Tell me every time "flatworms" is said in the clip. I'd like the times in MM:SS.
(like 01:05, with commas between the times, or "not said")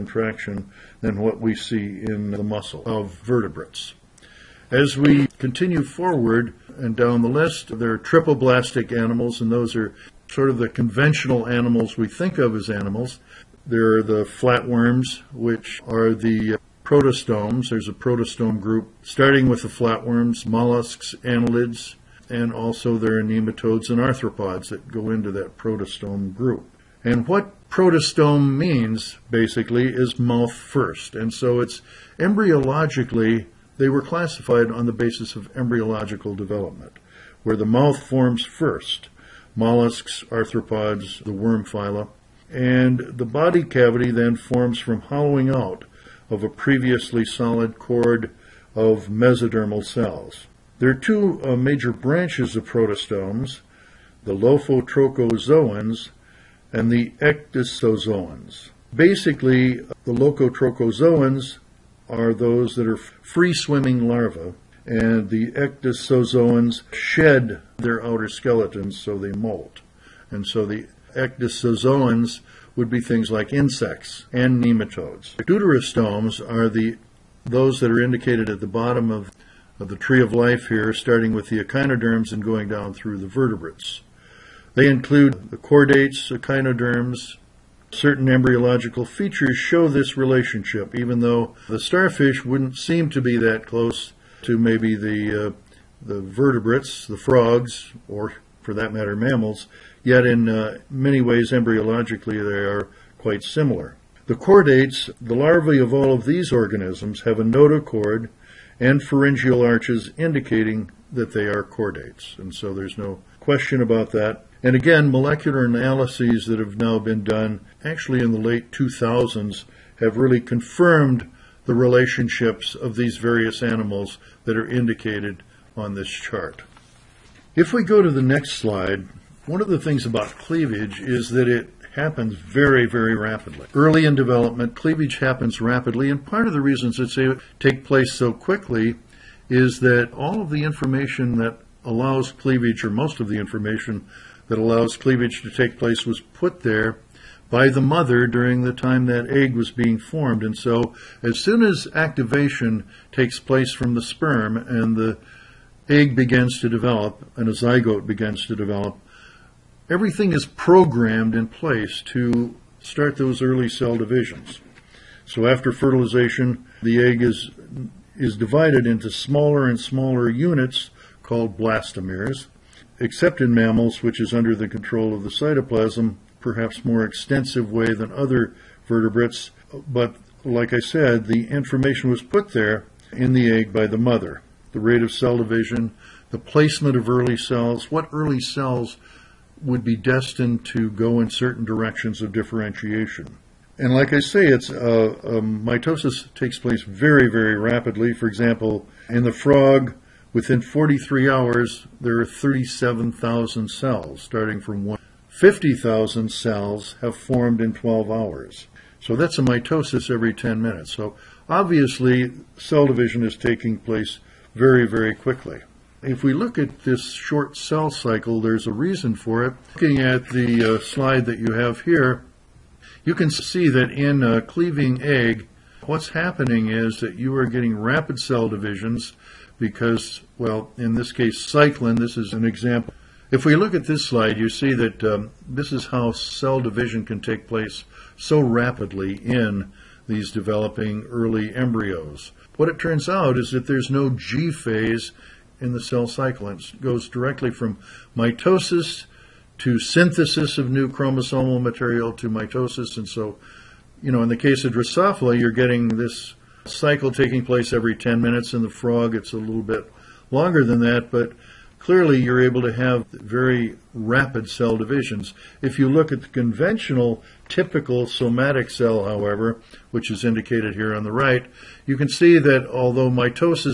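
00:14, 00:19.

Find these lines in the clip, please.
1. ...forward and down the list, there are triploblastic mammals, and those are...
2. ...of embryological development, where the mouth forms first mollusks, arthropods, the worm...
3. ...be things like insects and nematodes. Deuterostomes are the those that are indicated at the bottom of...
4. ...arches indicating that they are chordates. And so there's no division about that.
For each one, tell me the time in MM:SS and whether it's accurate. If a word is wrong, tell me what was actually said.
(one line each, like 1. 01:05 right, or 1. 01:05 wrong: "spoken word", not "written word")
1. 00:05 wrong: "animals", not "mammals"
2. 00:35 right
3. 01:12 right
4. 01:49 wrong: "question", not "division".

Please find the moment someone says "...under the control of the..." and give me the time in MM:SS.
02:54.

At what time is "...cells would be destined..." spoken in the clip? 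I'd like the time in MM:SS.
03:08.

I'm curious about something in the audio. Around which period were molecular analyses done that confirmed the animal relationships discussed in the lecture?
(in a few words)
late 2000s.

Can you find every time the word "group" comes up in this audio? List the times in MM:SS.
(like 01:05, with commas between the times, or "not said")
00:18, 00:26.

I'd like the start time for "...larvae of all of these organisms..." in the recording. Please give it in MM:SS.
01:45.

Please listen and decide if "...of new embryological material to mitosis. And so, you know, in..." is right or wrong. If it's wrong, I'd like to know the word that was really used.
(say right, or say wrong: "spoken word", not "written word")
wrong: "chromosomal", not "embryological".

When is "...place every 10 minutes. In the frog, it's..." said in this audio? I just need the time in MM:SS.
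04:17.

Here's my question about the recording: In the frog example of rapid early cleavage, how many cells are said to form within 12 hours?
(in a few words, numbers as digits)
50,000.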